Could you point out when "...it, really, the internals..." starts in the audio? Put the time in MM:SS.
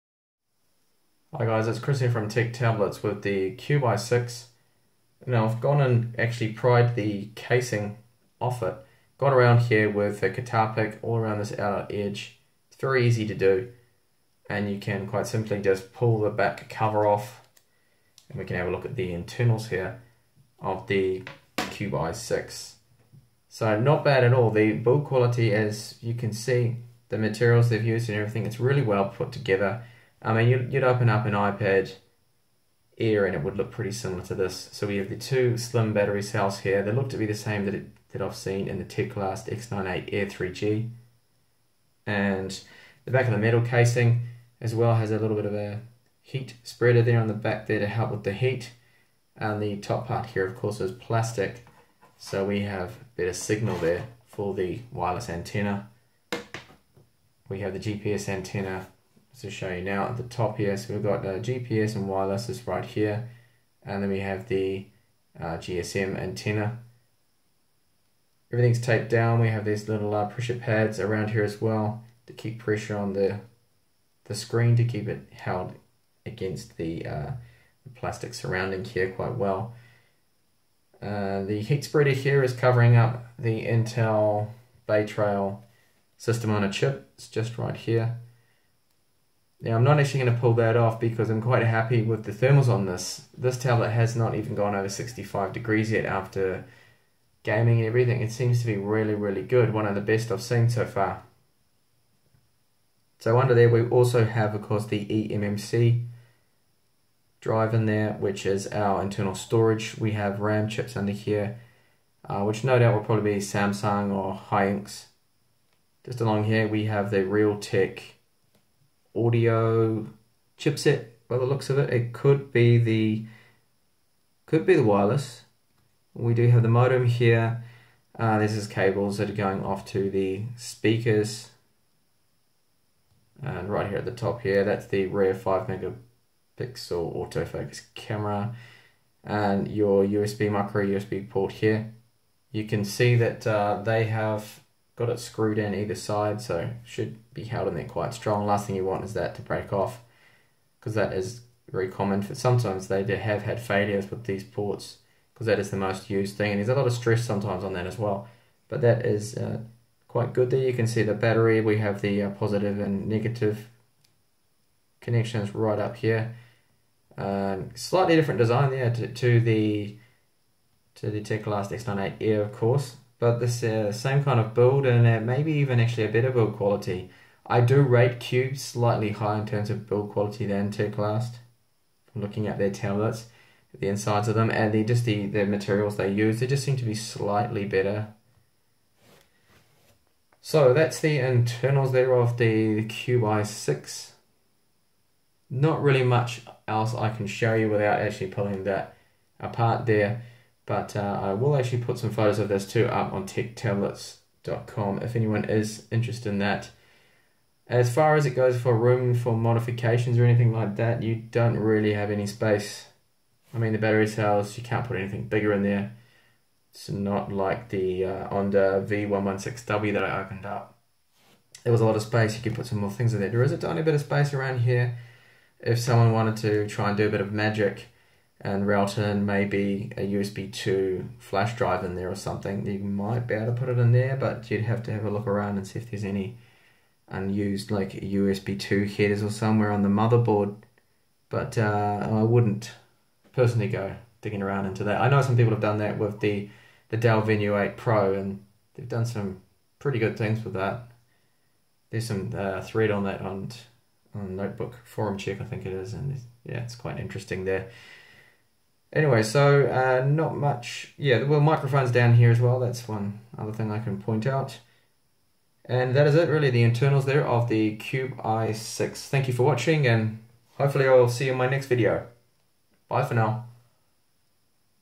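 04:26.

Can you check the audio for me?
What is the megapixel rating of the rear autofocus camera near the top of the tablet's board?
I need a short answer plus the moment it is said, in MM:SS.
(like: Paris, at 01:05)
5, at 02:15.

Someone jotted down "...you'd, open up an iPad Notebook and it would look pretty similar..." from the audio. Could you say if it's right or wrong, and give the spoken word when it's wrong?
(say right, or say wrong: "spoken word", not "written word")
wrong: "Air", not "Notebook".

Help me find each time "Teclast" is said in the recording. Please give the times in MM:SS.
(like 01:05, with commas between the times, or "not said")
00:38, 02:51, 03:00.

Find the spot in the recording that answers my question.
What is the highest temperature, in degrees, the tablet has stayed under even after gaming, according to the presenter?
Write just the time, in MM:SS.
01:34.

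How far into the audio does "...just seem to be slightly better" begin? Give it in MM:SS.
03:06.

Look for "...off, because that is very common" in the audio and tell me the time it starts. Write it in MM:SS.
02:29.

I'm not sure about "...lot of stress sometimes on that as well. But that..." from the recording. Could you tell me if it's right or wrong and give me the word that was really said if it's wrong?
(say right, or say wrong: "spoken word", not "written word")
right.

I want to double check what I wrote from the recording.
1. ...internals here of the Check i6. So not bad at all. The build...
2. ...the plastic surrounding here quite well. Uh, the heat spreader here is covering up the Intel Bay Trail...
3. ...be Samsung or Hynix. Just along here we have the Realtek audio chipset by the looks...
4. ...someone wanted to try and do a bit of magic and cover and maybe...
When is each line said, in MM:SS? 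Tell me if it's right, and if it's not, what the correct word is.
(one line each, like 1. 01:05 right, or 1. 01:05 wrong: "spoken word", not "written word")
1. 00:19 wrong: "Cube", not "Check"
2. 01:17 right
3. 01:53 right
4. 03:45 wrong: "router", not "cover".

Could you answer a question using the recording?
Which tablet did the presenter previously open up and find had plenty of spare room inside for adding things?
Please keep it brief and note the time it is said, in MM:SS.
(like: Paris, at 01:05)
Onda V116W, at 03:38.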